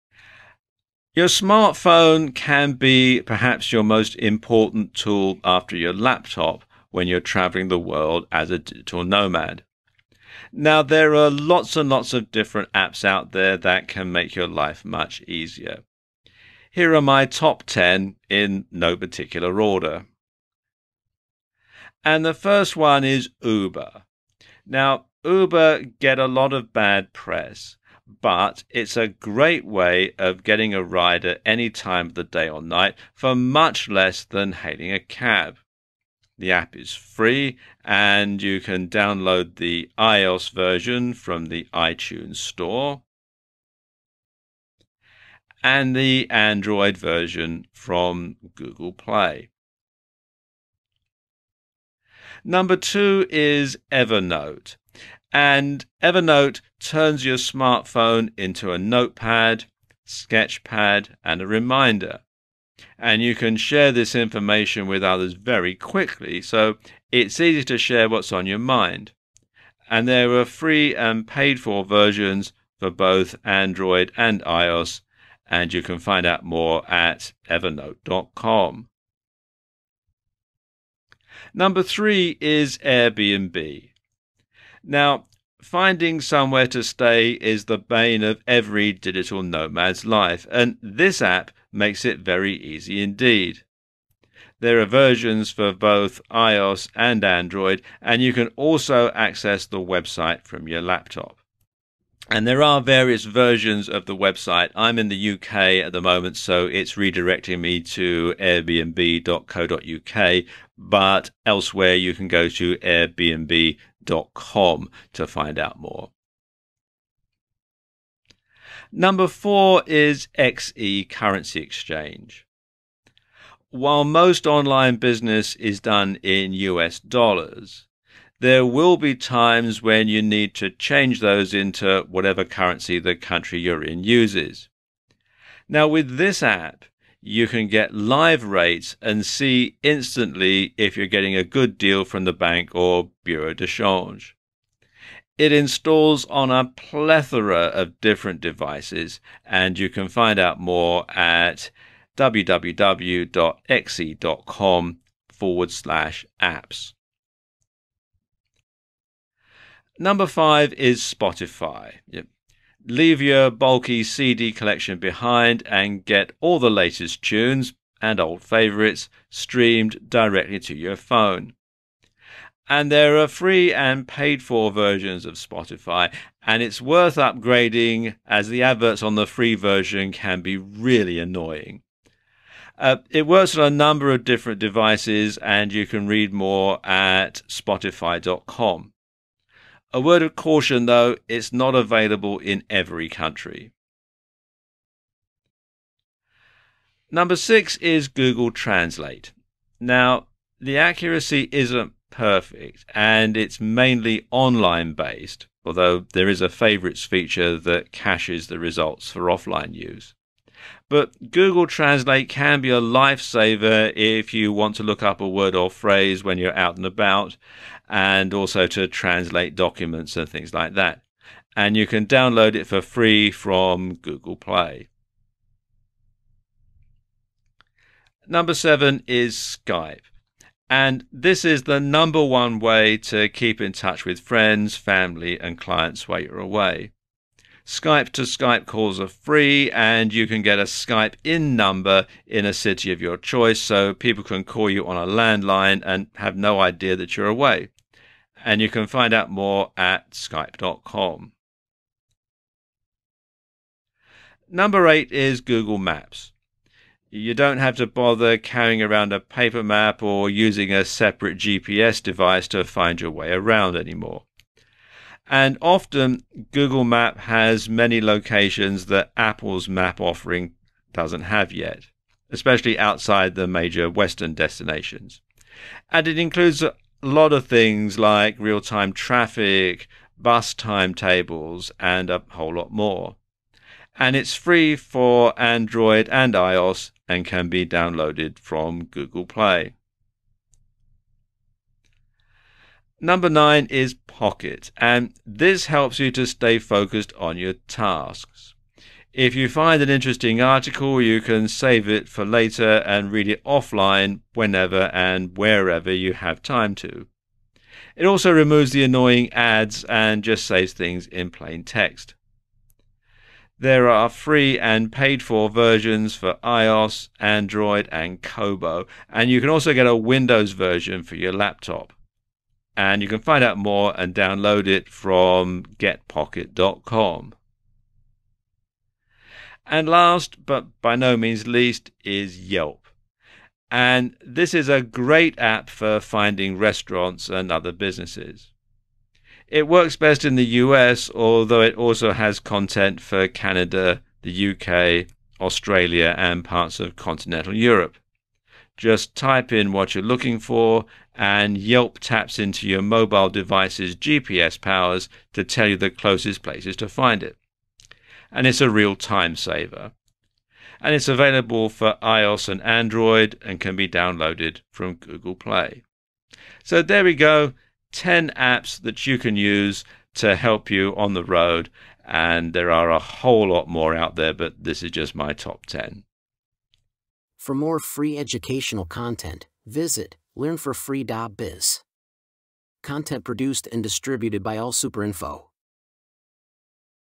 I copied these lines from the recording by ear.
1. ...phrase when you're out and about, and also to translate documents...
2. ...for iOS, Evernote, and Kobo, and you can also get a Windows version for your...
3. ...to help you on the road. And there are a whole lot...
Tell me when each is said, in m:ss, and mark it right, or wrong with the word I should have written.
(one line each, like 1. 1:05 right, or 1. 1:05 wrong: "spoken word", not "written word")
1. 3:35 right
2. 5:16 wrong: "Android", not "Evernote"
3. 6:10 right.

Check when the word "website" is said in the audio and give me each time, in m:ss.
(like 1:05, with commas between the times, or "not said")
1:39, 1:44.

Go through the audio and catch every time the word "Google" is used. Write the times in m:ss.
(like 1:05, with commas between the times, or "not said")
0:48, 3:18, 3:31, 3:44, 4:15, 4:26, 4:48, 6:04.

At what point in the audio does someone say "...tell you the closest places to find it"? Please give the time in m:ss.
5:55.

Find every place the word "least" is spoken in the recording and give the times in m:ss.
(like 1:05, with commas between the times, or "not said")
5:31.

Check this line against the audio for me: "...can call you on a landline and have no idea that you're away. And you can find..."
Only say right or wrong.
right.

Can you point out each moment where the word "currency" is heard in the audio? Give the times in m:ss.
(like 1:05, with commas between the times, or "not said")
2:01, 2:12.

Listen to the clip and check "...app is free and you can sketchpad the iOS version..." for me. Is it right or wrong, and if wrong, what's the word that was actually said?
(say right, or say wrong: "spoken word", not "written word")
wrong: "download", not "sketchpad".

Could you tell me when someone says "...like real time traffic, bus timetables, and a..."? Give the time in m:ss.
4:37.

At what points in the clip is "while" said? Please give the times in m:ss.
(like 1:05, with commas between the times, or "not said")
2:03, 3:56.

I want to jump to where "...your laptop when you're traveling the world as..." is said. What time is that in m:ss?
0:05.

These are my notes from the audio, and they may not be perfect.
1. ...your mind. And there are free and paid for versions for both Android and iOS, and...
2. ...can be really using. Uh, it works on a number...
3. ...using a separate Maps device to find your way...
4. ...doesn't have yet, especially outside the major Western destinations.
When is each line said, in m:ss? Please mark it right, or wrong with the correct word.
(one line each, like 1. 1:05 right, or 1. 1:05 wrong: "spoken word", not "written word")
1. 1:08 right
2. 3:00 wrong: "annoying", not "using"
3. 4:20 wrong: "GPS", not "Maps"
4. 4:30 right.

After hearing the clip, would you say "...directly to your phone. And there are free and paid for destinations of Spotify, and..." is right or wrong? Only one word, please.
wrong.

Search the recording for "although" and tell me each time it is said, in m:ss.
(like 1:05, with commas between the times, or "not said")
3:25, 5:41.